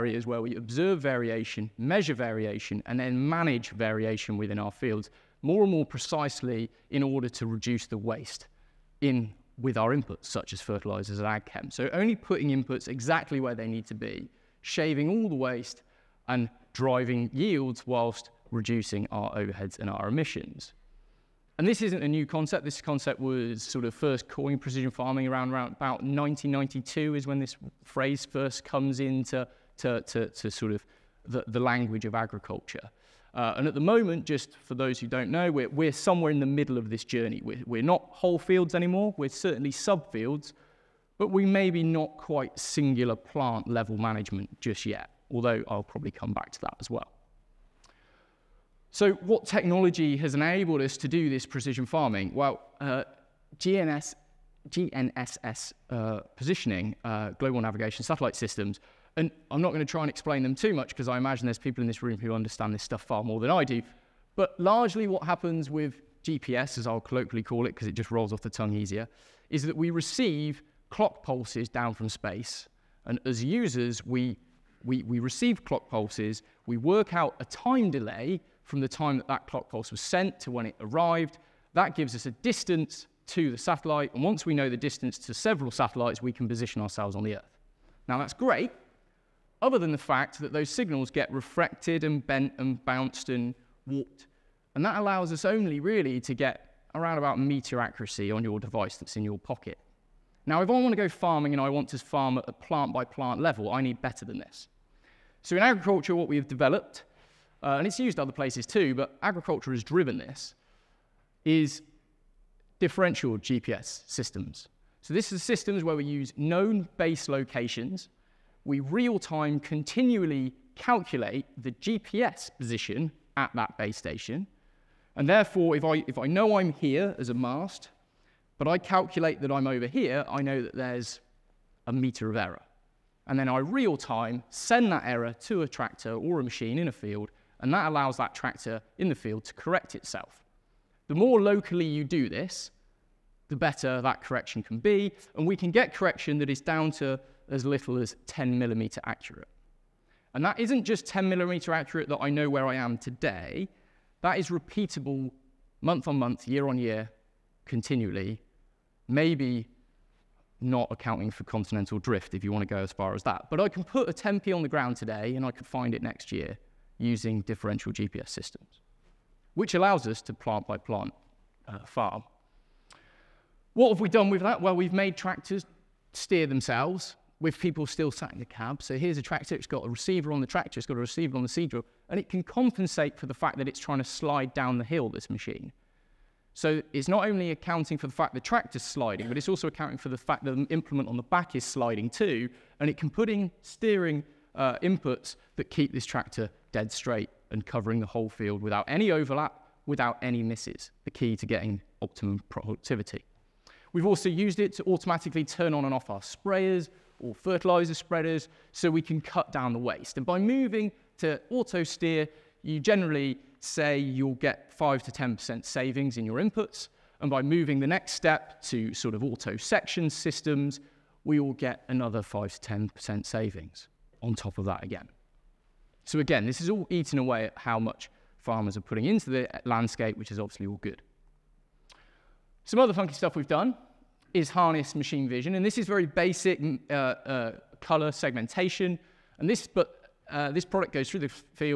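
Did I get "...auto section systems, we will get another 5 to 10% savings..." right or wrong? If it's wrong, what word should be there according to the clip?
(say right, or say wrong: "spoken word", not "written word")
right.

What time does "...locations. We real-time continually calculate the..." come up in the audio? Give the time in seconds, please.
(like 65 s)
117 s.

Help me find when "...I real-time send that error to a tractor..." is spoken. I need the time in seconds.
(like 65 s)
133 s.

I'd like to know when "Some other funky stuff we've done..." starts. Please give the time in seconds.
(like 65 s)
232 s.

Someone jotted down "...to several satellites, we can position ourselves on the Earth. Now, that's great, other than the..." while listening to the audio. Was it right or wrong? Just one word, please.
right.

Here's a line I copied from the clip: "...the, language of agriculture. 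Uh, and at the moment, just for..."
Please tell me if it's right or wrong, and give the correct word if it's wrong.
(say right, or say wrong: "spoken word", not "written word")
right.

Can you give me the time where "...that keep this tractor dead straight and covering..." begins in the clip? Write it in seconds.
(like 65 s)
195 s.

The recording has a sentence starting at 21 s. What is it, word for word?
And this isn't a new concept.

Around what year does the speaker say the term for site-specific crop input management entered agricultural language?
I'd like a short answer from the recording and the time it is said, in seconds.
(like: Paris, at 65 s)
1992, at 26 s.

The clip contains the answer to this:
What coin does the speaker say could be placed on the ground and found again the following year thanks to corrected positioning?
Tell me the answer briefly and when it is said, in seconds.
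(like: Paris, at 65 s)
10p, at 164 s.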